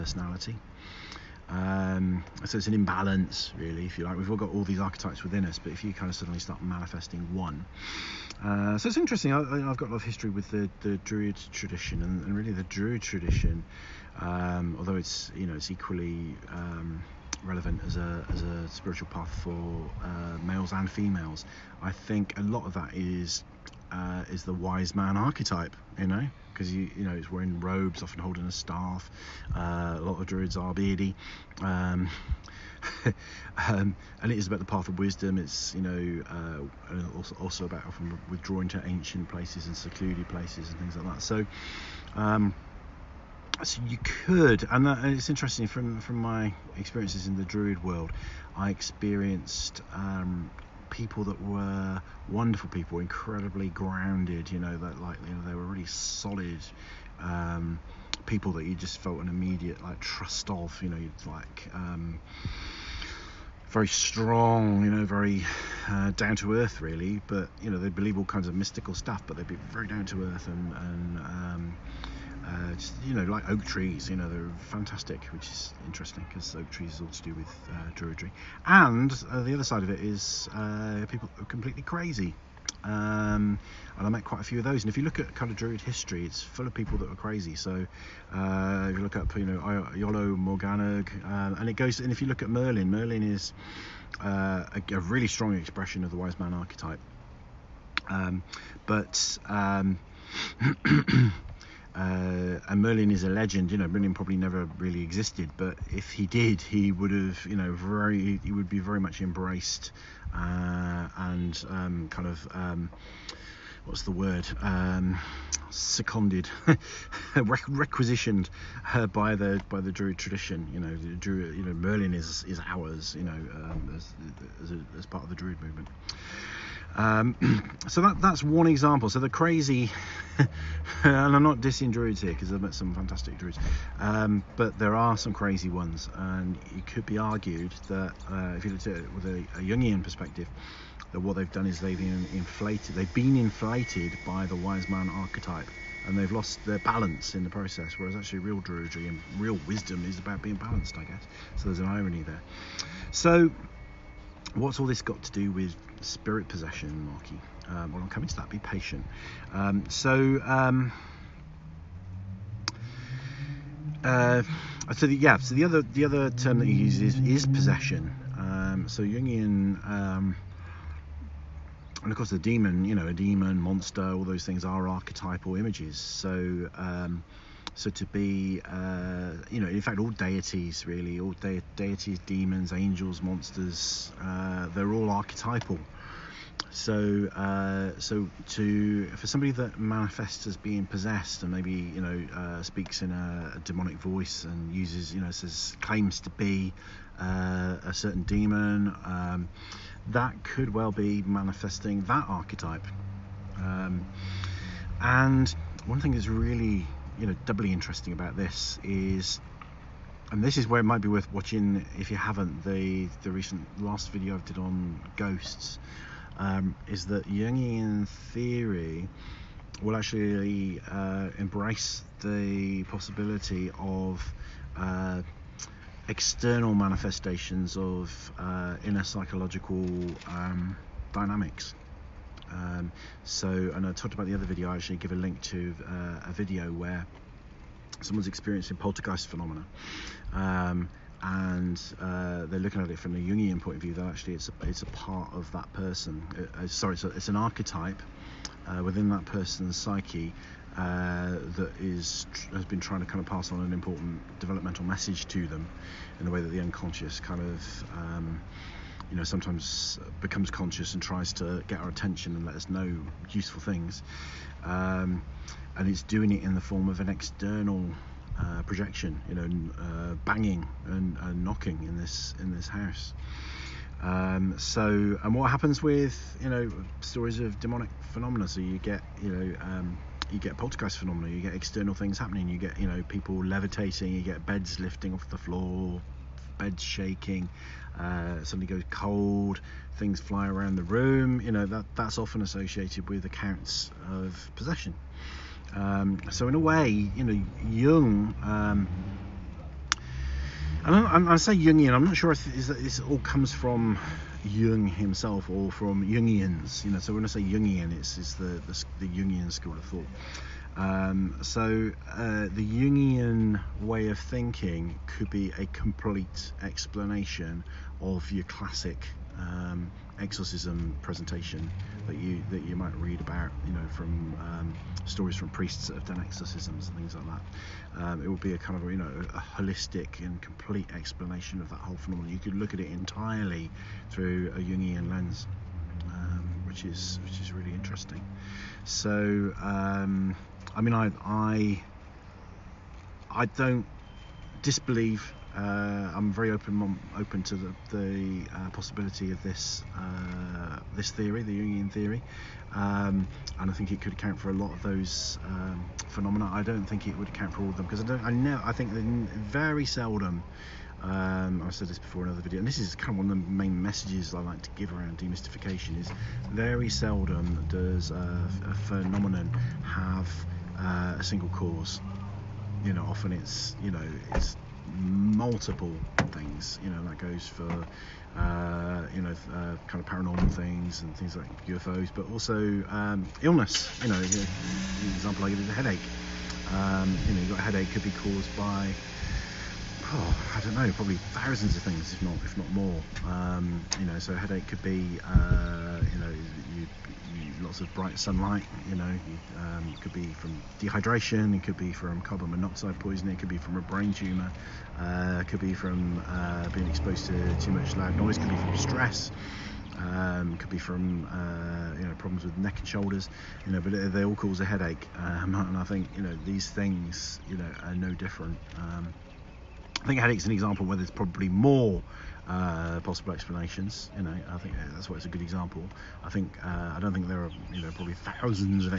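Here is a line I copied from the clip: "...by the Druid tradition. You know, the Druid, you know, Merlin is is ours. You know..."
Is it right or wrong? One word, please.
right.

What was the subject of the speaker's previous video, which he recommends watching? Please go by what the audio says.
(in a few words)
Ghosts.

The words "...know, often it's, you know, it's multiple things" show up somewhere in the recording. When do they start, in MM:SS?
06:12.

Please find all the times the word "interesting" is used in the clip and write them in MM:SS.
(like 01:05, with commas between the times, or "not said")
00:08, 00:45, 01:15, 03:27, 05:37.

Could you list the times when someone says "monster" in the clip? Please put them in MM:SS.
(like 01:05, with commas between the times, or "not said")
02:53, 03:03.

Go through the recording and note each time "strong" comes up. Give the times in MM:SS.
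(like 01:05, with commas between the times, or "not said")
01:03, 01:35.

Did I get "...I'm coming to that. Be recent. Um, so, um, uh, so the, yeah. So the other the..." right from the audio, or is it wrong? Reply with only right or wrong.
wrong.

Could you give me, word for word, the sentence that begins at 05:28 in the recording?
Um, it would be a kind of you know a holistic and complete explanation of that whole phenomenon.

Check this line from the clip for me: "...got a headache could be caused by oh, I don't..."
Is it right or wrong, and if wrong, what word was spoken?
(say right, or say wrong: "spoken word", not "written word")
right.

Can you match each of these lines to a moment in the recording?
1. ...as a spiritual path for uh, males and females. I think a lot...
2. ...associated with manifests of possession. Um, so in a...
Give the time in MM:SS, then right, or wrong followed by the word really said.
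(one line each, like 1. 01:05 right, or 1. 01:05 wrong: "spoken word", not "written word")
1. 00:18 right
2. 04:52 wrong: "accounts", not "manifests".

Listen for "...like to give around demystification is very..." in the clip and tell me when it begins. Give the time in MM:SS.
06:04.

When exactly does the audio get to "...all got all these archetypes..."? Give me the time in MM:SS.
00:04.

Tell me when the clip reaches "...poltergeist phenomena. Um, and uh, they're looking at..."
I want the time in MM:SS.
03:58.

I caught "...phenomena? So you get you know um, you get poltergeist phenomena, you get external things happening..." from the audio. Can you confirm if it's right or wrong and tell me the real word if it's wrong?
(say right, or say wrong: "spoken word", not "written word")
right.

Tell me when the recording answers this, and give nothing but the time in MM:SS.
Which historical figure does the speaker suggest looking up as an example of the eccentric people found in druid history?
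01:29.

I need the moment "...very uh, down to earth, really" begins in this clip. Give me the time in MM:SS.
01:05.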